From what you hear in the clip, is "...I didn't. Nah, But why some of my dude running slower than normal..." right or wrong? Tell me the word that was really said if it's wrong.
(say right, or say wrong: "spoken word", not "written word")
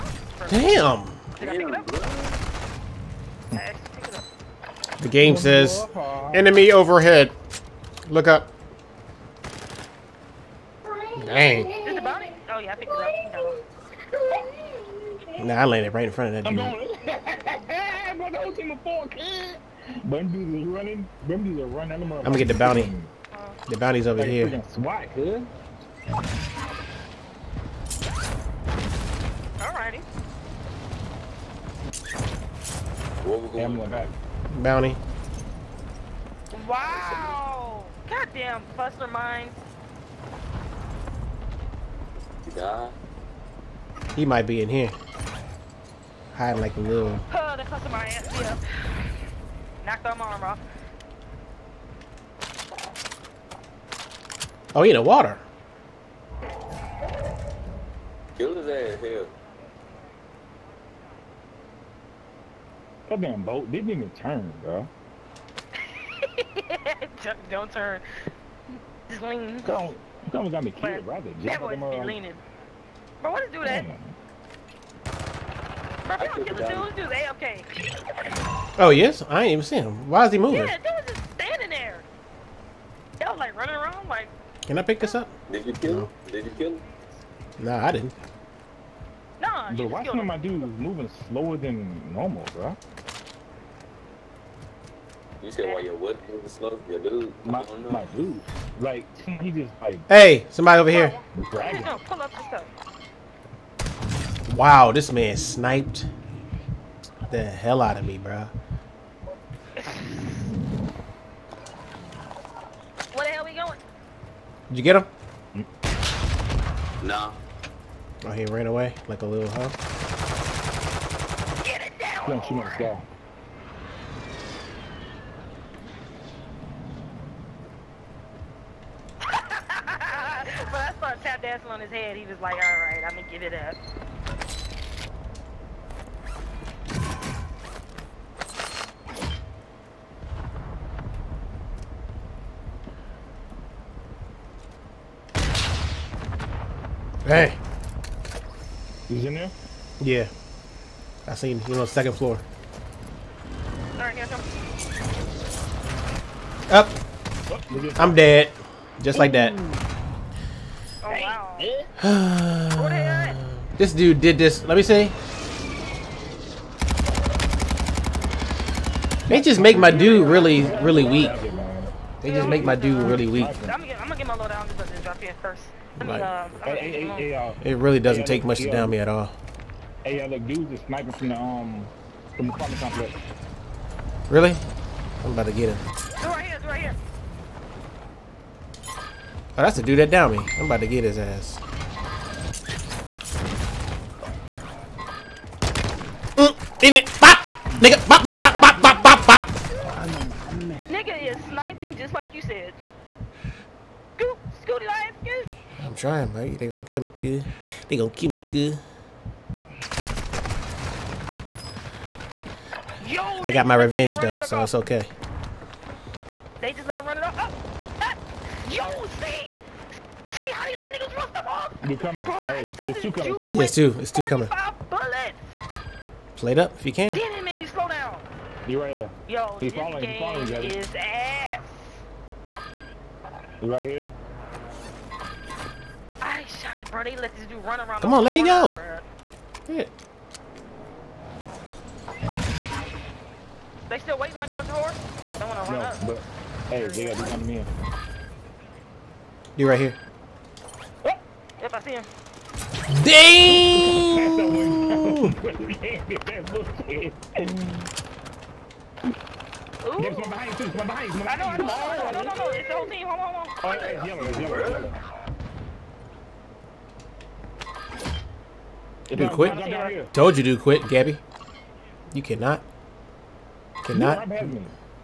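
wrong: "moving", not "running".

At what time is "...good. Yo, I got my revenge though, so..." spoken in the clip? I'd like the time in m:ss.
3:28.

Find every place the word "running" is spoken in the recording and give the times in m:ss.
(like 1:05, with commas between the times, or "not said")
0:20, 1:23.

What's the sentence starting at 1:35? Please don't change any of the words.
You said why your wood moving slow?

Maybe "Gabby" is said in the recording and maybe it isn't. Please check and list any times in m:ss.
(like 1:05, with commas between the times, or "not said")
4:30.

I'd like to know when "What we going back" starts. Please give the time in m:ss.
0:33.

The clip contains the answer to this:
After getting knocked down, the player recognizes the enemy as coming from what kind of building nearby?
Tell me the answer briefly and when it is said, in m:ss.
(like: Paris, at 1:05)
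Apartment complex, at 3:02.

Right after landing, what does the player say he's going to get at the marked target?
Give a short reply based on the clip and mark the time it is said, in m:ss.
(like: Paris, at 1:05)
The bounty, at 0:21.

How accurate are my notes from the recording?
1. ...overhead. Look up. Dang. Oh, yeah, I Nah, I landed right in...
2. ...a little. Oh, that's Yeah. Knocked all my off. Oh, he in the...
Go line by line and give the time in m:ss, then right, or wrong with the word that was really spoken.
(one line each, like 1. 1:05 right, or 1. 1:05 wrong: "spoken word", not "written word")
1. 0:06 right
2. 0:46 right.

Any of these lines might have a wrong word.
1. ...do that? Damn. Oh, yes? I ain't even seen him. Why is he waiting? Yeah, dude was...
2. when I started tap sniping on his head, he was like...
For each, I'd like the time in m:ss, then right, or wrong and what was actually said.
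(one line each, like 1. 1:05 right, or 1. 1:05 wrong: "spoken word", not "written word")
1. 1:13 wrong: "moving", not "waiting"
2. 2:10 wrong: "dancing", not "sniping".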